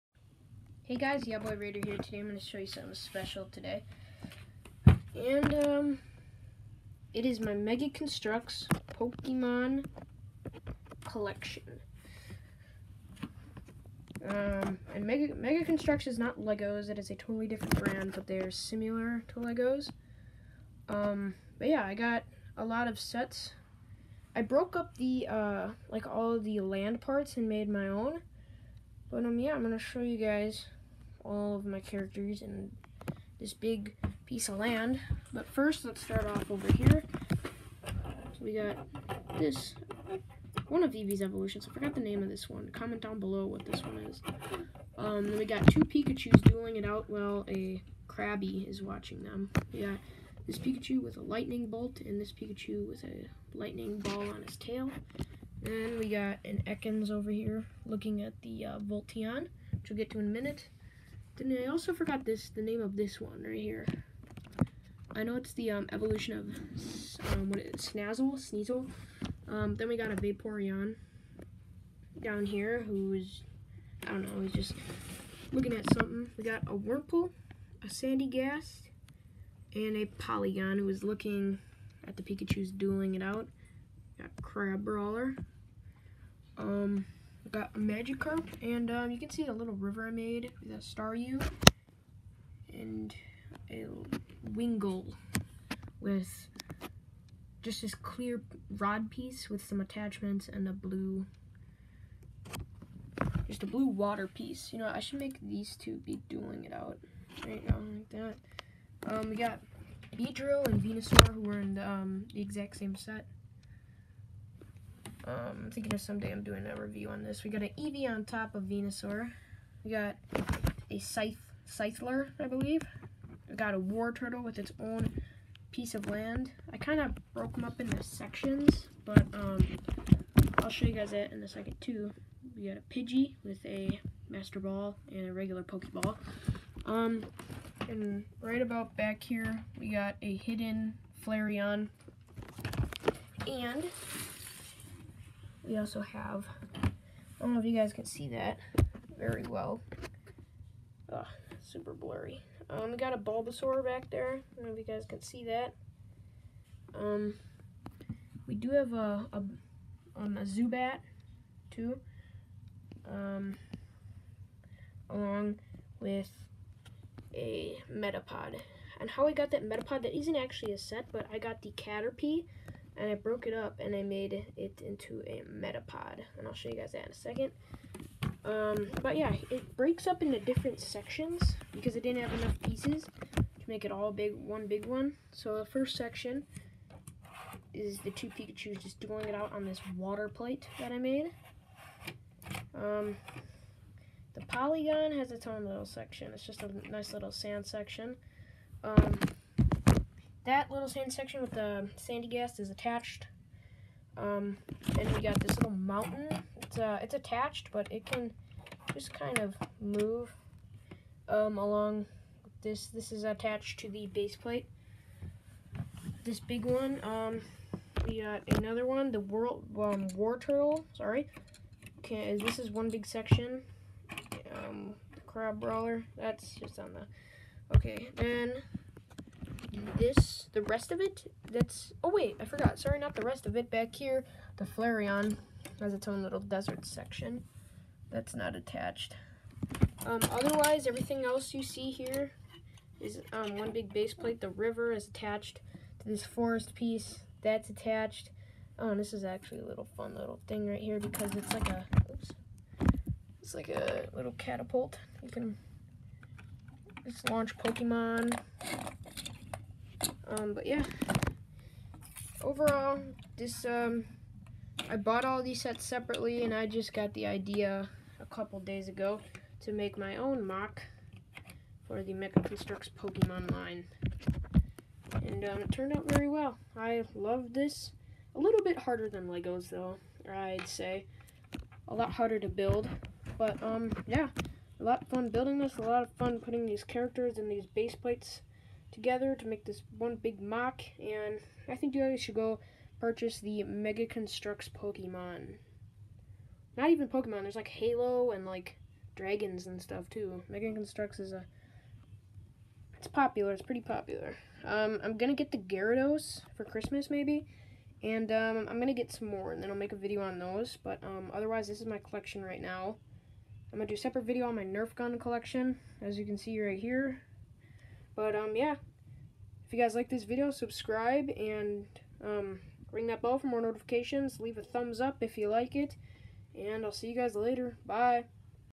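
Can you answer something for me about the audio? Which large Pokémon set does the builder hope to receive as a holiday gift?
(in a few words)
Gyarados.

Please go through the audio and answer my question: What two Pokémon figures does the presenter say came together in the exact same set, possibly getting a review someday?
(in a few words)
Beedrill and Venusaur.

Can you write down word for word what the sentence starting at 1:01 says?
Then I also forgot this, the name of this one right here.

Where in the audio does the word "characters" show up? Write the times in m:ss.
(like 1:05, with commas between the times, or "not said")
0:31, 4:46.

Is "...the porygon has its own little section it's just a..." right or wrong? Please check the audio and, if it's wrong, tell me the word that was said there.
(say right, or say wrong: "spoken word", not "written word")
right.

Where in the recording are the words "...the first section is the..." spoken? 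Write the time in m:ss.
3:05.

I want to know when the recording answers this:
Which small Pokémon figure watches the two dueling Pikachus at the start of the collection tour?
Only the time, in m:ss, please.
0:48.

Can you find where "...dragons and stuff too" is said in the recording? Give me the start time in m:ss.
4:59.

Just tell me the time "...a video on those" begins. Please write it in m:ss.
5:09.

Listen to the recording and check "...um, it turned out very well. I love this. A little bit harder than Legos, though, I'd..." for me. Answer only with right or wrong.
right.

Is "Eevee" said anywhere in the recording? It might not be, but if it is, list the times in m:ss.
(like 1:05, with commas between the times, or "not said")
0:40, 1:57.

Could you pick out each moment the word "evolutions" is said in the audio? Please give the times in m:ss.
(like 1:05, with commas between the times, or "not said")
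0:41, 1:05.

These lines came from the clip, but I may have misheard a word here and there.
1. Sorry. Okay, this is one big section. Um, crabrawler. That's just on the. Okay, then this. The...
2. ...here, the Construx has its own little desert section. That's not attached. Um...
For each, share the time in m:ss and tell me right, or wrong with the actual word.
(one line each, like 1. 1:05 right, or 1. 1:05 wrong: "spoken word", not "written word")
1. 3:40 right
2. 3:53 wrong: "Flareon", not "Construx".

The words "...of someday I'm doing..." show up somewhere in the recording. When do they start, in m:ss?
1:55.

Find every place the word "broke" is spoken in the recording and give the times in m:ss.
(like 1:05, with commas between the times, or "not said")
0:24, 2:07, 2:53.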